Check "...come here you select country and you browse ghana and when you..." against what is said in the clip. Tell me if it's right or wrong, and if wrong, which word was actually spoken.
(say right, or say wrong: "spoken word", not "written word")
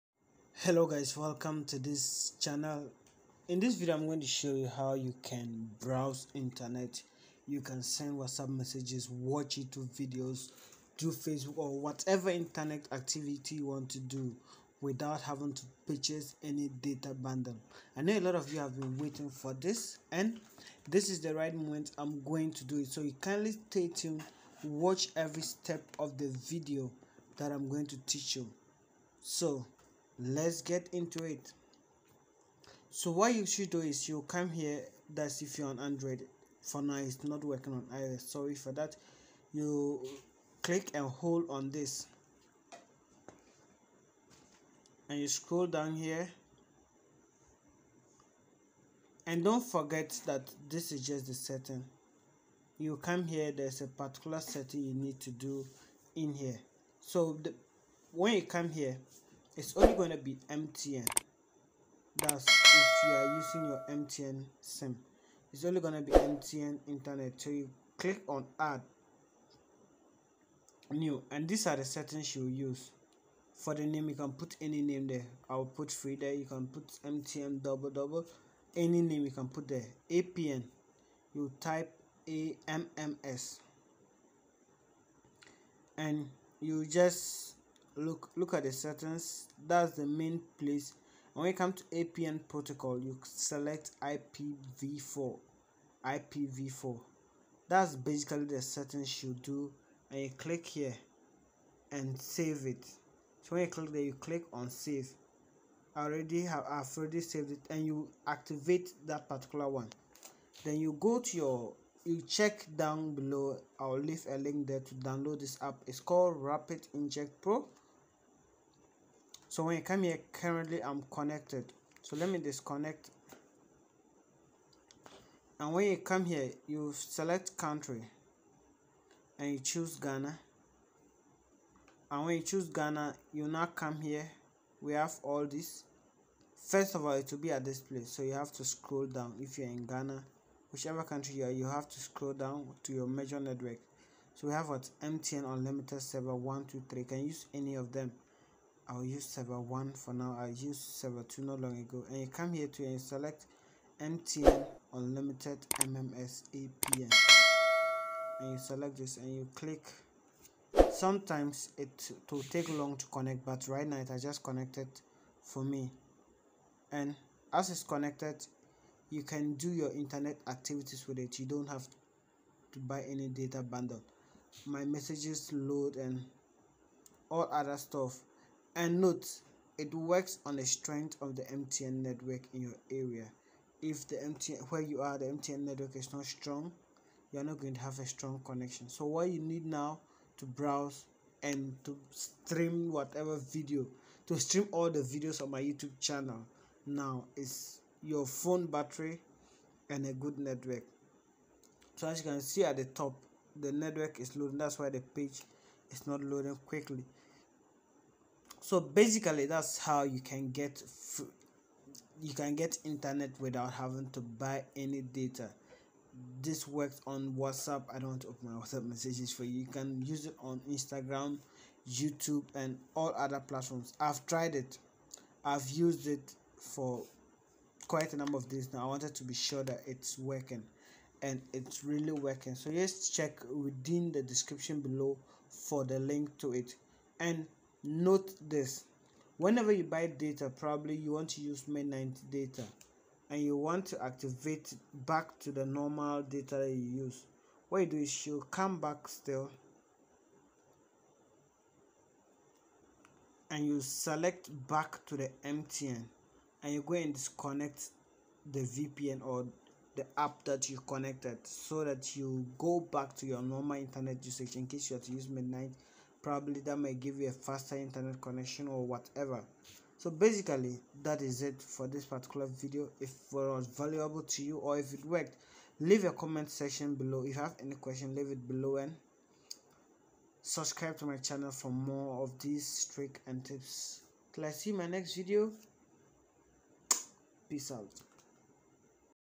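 wrong: "choose", not "browse".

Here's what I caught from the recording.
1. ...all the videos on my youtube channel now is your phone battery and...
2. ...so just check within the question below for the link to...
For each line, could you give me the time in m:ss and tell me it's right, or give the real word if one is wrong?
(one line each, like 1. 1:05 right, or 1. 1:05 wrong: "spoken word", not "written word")
1. 3:14 right
2. 3:52 wrong: "description", not "question".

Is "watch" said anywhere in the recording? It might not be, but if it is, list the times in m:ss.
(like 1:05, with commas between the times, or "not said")
0:09, 0:24.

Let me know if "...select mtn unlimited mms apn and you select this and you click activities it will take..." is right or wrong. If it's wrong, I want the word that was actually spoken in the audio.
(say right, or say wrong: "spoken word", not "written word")
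wrong: "sometimes", not "activities".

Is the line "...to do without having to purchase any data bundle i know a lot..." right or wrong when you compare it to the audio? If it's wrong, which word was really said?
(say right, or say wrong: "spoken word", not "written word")
right.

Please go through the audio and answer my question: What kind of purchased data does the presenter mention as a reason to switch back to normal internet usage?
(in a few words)
Midnight data.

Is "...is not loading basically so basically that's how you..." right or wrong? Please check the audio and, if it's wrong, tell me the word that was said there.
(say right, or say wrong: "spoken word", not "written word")
wrong: "quickly", not "basically".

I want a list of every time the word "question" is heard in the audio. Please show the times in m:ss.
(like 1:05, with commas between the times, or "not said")
4:37.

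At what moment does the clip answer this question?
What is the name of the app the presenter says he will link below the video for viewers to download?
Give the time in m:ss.
1:56.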